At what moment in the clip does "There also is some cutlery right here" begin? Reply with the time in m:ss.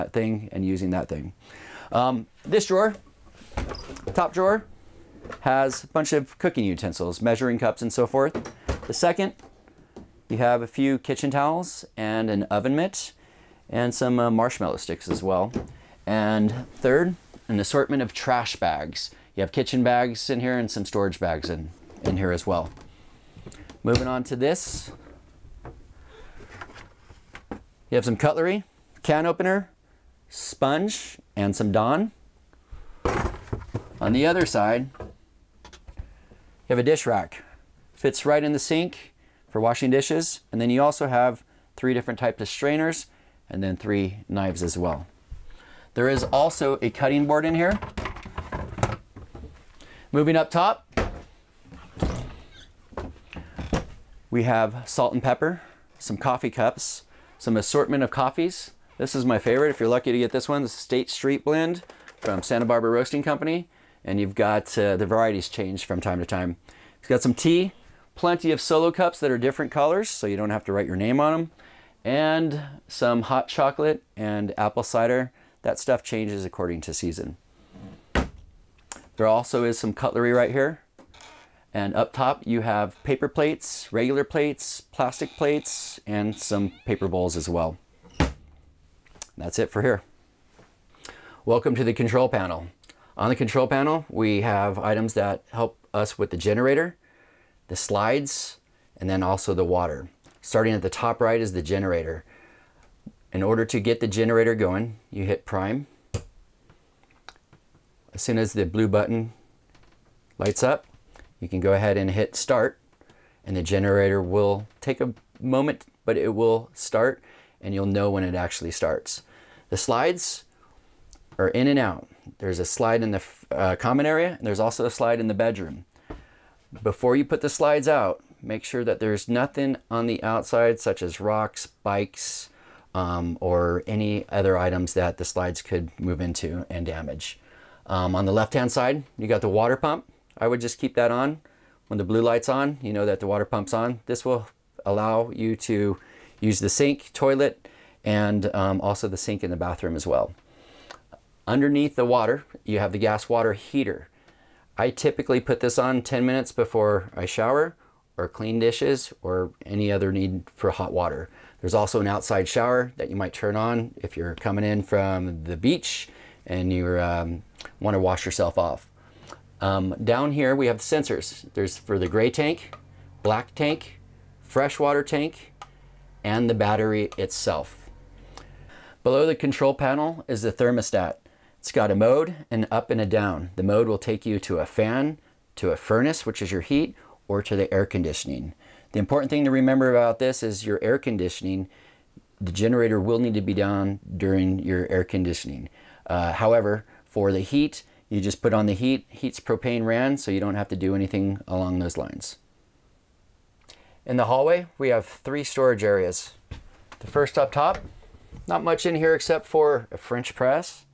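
1:19.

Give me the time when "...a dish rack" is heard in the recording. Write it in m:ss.
0:36.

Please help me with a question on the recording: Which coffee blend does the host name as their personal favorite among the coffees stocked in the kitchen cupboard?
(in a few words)
State Street Blend.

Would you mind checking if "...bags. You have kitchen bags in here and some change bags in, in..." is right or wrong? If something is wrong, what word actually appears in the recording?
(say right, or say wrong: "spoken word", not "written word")
wrong: "storage", not "change".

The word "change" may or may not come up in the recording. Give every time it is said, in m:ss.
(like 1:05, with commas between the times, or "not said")
1:05, 1:16.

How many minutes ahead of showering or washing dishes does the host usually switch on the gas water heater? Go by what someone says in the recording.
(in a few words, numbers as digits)
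10.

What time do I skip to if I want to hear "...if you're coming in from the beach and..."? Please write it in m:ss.
2:43.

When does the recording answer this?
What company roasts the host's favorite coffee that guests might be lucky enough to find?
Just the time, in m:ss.
1:02.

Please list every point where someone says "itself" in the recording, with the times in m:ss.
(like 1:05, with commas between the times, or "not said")
2:57.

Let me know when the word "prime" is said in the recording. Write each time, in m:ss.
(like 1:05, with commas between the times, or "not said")
1:45.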